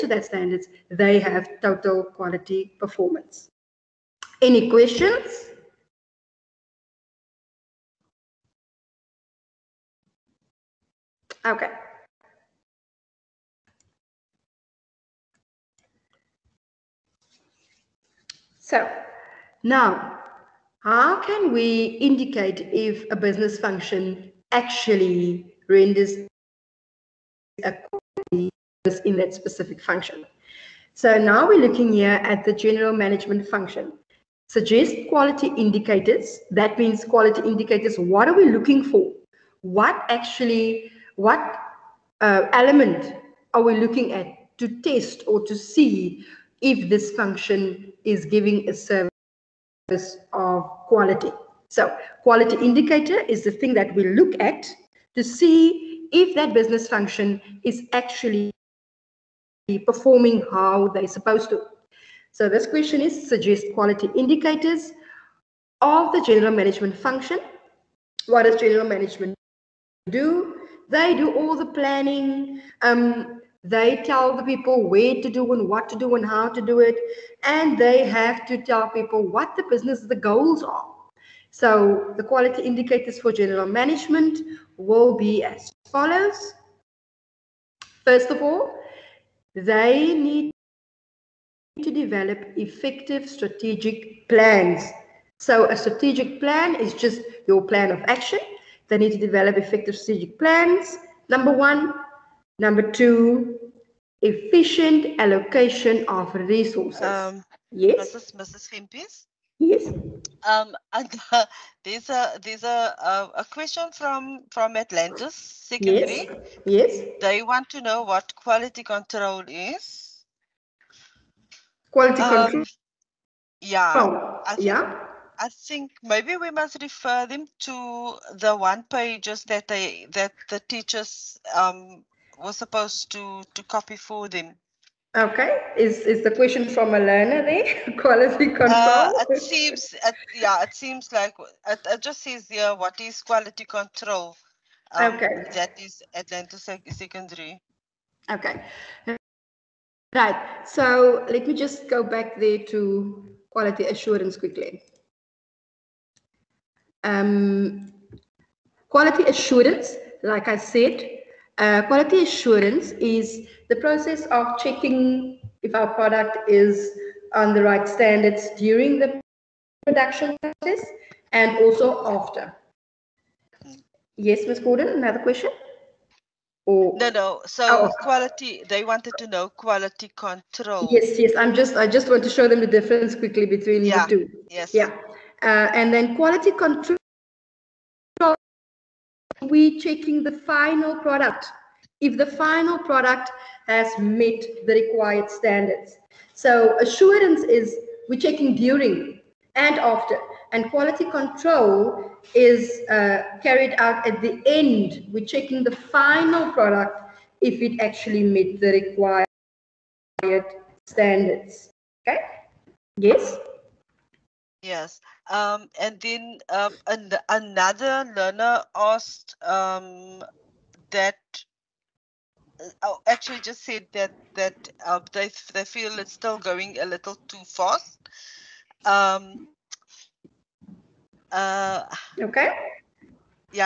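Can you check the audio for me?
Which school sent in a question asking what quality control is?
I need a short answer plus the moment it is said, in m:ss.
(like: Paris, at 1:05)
Atlantis Secondary, at 1:54.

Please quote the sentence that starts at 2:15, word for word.
Okay, is is the question from a learner there?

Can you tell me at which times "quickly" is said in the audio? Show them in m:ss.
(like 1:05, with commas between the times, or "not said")
2:34, 3:03.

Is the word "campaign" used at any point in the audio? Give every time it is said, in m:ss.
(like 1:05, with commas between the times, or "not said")
not said.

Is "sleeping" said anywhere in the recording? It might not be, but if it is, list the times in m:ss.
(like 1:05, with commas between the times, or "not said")
not said.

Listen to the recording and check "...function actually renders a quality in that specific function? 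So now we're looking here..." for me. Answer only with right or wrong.
right.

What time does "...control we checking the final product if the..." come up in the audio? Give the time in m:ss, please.
3:06.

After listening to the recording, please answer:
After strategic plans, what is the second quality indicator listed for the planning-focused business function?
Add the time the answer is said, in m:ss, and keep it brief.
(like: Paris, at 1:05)
Efficient allocation of resources, at 1:44.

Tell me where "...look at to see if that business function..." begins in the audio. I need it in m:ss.
0:54.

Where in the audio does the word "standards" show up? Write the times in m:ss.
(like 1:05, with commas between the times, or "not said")
0:00, 2:47, 3:15, 3:30.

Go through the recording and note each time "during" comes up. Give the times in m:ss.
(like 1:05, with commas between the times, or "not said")
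2:48, 3:18.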